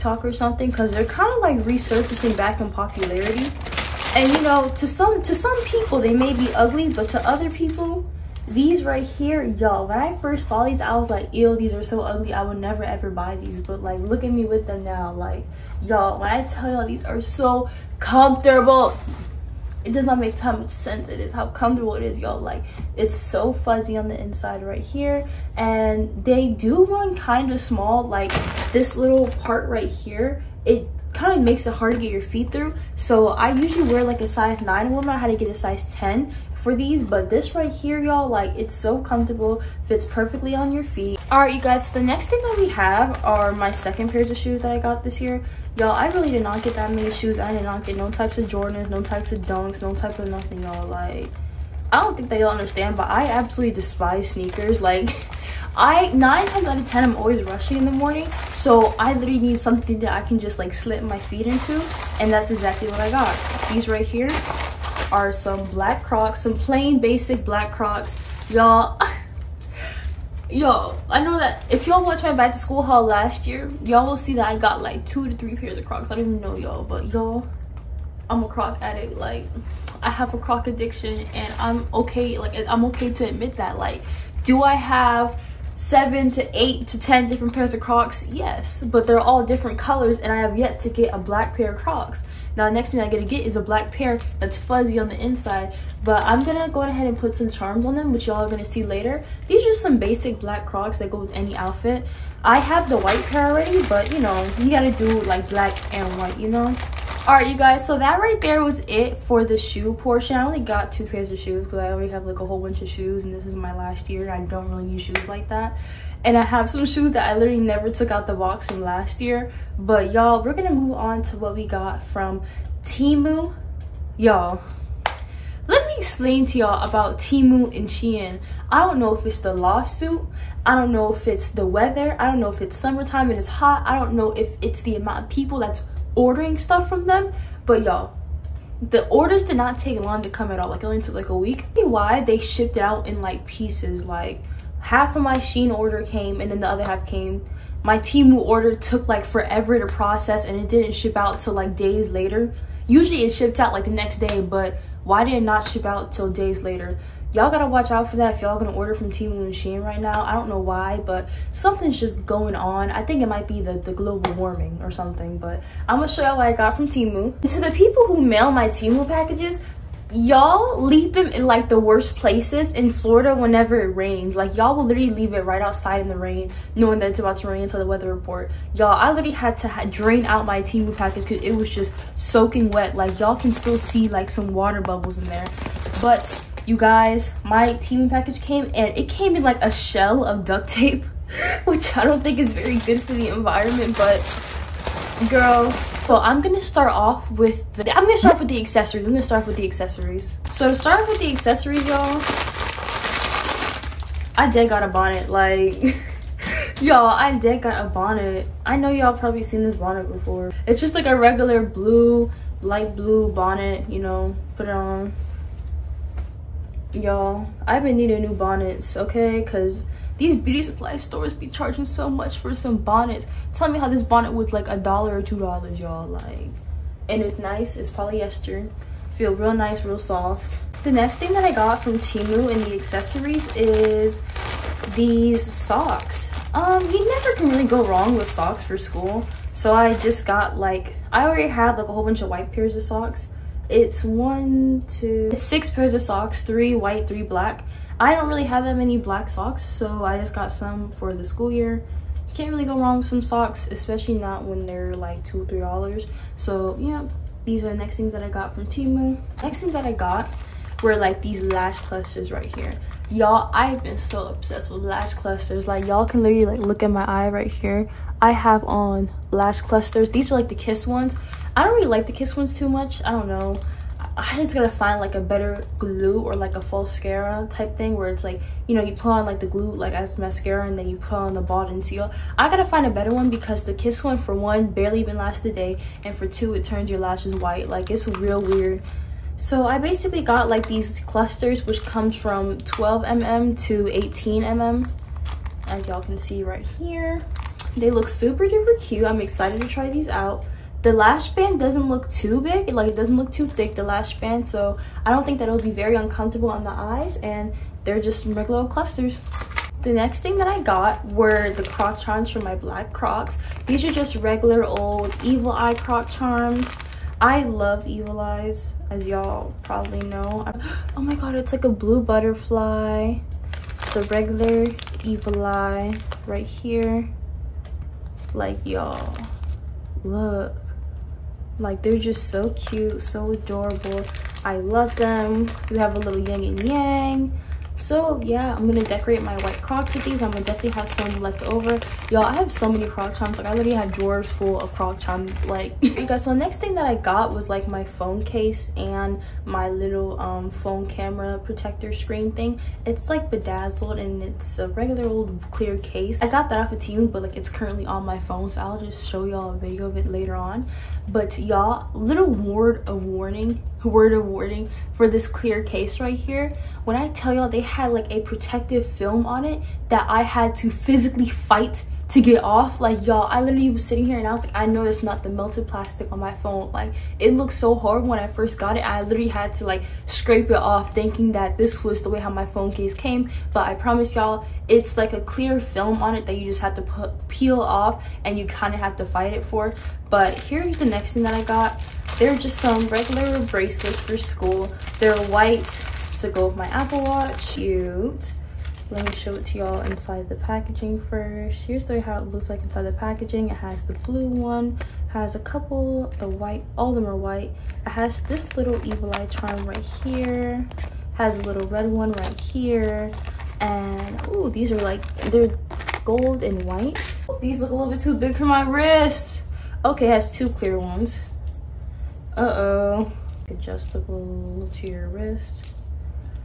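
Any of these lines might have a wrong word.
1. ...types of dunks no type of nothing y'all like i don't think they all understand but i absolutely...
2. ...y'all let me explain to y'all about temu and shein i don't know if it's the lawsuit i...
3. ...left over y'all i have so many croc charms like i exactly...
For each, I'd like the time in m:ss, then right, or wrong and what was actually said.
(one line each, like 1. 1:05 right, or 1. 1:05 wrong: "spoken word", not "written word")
1. 0:49 right
2. 2:04 right
3. 5:41 wrong: "literally", not "exactly".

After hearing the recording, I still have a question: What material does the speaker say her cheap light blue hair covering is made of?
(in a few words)
Polyester.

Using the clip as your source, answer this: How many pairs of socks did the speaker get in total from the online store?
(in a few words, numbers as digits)
6.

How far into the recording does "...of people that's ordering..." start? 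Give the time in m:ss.
2:15.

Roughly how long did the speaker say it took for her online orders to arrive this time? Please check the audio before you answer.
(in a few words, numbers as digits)
A week.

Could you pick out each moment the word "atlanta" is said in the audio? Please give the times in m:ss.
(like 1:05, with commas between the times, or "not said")
not said.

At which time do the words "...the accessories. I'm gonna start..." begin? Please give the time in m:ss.
3:18.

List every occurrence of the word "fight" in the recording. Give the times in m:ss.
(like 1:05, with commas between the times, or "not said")
6:11, 6:29.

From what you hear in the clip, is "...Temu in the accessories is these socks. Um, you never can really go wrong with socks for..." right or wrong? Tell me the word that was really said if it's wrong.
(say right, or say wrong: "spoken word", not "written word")
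right.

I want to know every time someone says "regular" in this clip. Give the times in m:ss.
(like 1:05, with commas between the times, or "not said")
3:31, 5:08, 5:14, 5:24, 5:54, 6:32.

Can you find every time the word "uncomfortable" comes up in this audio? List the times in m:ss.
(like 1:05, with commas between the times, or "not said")
5:05.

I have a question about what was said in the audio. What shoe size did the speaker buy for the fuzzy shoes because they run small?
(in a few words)
10.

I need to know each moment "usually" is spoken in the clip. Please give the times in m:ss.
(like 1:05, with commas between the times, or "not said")
0:33, 2:32.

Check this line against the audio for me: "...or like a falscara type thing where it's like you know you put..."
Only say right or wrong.
right.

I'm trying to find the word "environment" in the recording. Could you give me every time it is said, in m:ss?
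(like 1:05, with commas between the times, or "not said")
3:13.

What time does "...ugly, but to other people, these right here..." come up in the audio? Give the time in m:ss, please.
0:06.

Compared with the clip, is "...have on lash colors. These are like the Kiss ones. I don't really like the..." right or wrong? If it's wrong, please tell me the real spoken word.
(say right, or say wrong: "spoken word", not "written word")
wrong: "clusters", not "colors".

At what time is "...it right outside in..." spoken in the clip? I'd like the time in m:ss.
2:55.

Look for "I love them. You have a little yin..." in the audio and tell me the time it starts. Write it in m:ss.
5:34.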